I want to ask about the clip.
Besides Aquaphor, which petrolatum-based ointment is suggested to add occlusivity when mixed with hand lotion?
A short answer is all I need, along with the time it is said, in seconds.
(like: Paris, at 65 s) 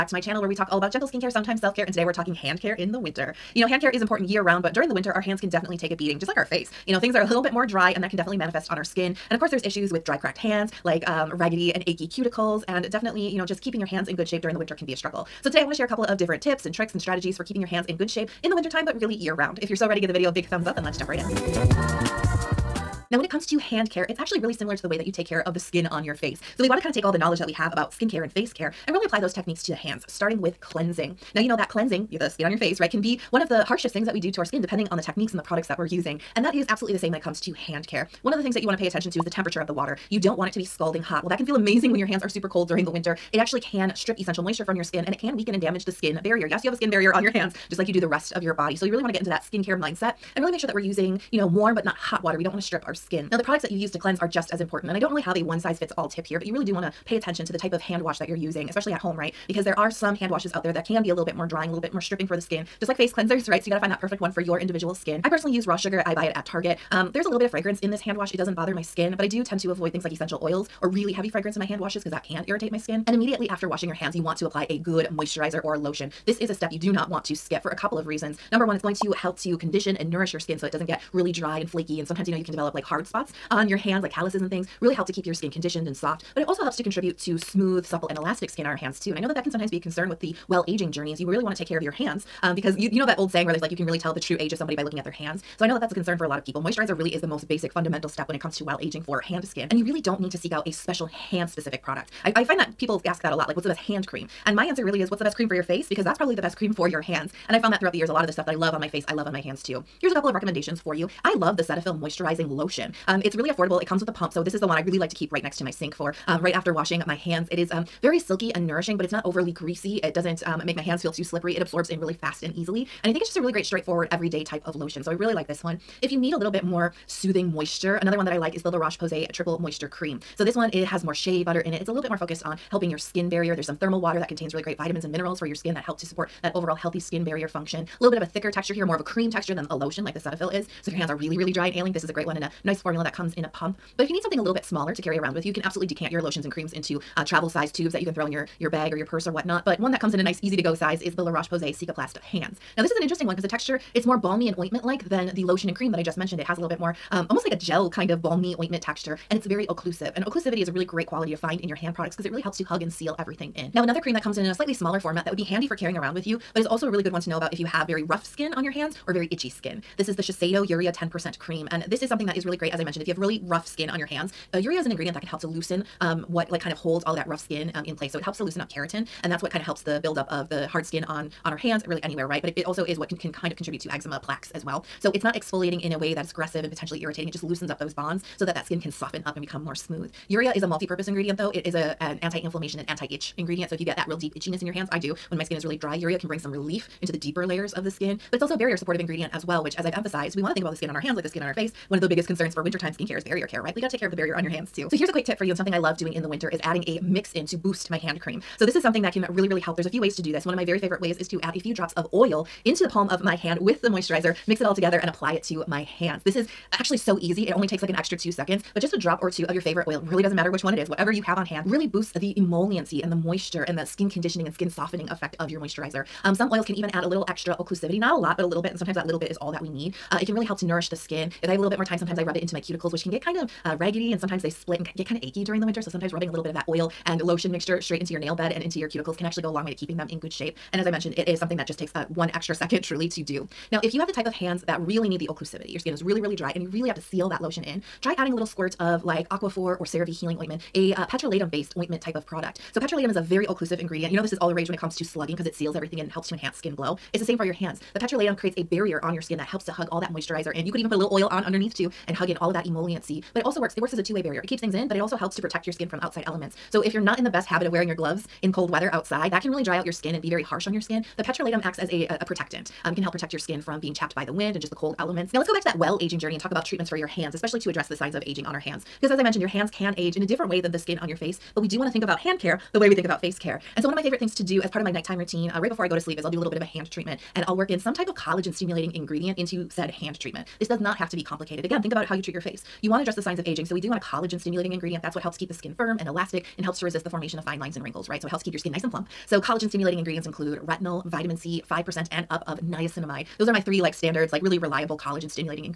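CeraVe Healing Ointment, at 249 s.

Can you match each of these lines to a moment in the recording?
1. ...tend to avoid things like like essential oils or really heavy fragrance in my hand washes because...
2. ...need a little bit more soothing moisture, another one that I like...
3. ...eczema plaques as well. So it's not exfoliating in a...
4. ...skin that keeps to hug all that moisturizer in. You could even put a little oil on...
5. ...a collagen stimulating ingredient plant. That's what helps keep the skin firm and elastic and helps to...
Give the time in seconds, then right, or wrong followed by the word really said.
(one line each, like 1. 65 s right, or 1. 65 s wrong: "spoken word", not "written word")
1. 69 s right
2. 126 s right
3. 183 s right
4. 259 s wrong: "helps", not "keeps"
5. 293 s right.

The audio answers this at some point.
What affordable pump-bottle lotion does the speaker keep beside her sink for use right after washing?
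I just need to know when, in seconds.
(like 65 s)
111 s.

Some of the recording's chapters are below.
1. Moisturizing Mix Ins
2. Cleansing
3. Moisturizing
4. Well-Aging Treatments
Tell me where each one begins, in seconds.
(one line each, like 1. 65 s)
1. 204 s
2. 22 s
3. 73 s
4. 274 s.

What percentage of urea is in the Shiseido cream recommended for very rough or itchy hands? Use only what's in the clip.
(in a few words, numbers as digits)
10%.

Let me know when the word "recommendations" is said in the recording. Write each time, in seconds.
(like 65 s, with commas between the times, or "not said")
110 s.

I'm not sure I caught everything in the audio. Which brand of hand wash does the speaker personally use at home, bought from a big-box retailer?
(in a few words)
Raw Sugar.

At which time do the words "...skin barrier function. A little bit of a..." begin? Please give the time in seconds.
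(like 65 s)
136 s.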